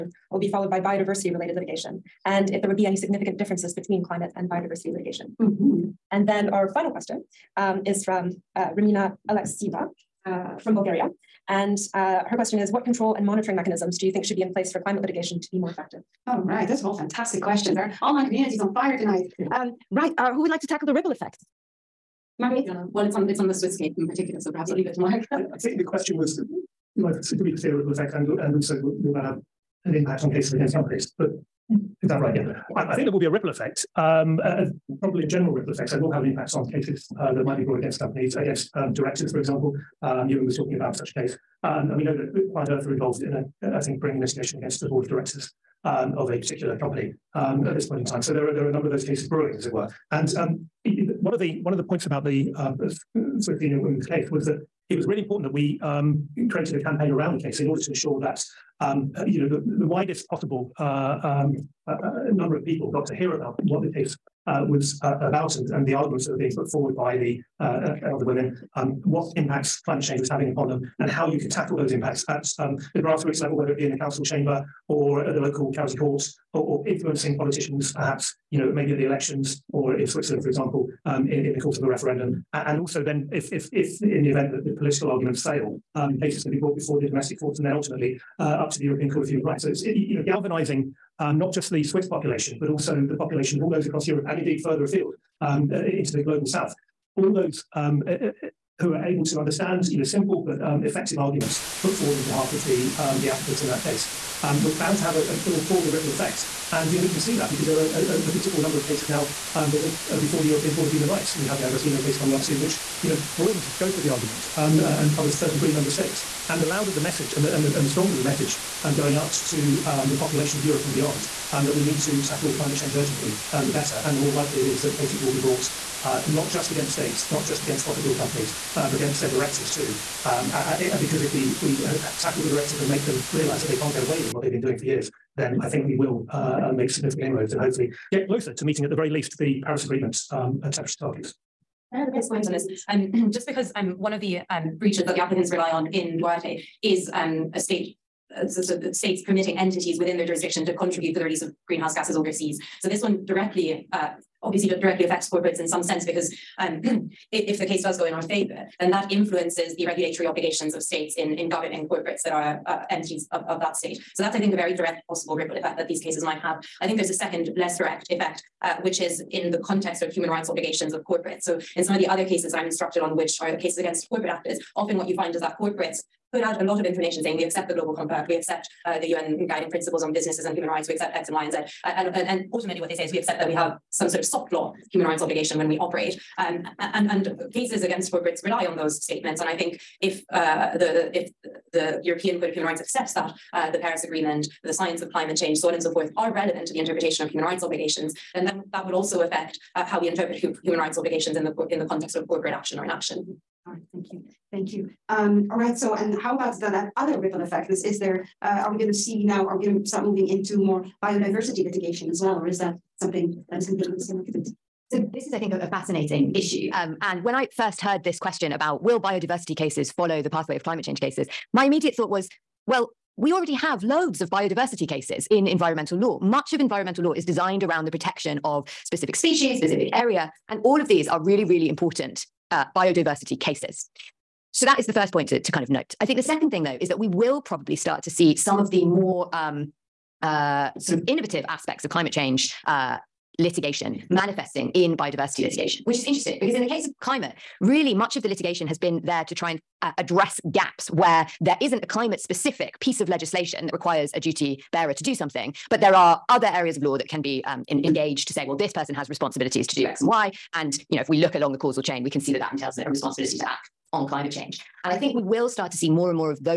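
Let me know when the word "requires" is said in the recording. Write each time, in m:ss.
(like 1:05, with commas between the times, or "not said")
4:13.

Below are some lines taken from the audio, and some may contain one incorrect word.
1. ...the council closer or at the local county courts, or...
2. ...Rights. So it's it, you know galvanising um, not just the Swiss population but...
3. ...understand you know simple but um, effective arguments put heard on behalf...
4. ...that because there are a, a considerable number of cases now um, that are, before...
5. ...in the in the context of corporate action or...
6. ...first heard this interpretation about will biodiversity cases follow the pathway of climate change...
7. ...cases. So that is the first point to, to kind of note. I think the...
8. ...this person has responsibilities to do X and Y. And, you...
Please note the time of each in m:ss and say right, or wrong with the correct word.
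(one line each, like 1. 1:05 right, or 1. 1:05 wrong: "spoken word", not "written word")
1. 1:13 wrong: "chamber", not "closer"
2. 1:29 right
3. 1:39 wrong: "forward", not "heard"
4. 1:47 right
5. 3:21 right
6. 3:37 wrong: "question", not "interpretation"
7. 3:53 right
8. 4:18 right.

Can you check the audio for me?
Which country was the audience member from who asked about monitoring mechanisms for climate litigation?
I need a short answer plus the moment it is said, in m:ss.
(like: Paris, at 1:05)
Bulgaria, at 0:10.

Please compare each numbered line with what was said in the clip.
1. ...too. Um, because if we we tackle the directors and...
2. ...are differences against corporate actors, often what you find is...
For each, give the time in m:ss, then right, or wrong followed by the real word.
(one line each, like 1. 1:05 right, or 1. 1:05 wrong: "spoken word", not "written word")
1. 2:09 right
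2. 2:53 wrong: "cases", not "differences".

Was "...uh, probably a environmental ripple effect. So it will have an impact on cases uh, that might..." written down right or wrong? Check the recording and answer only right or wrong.
wrong.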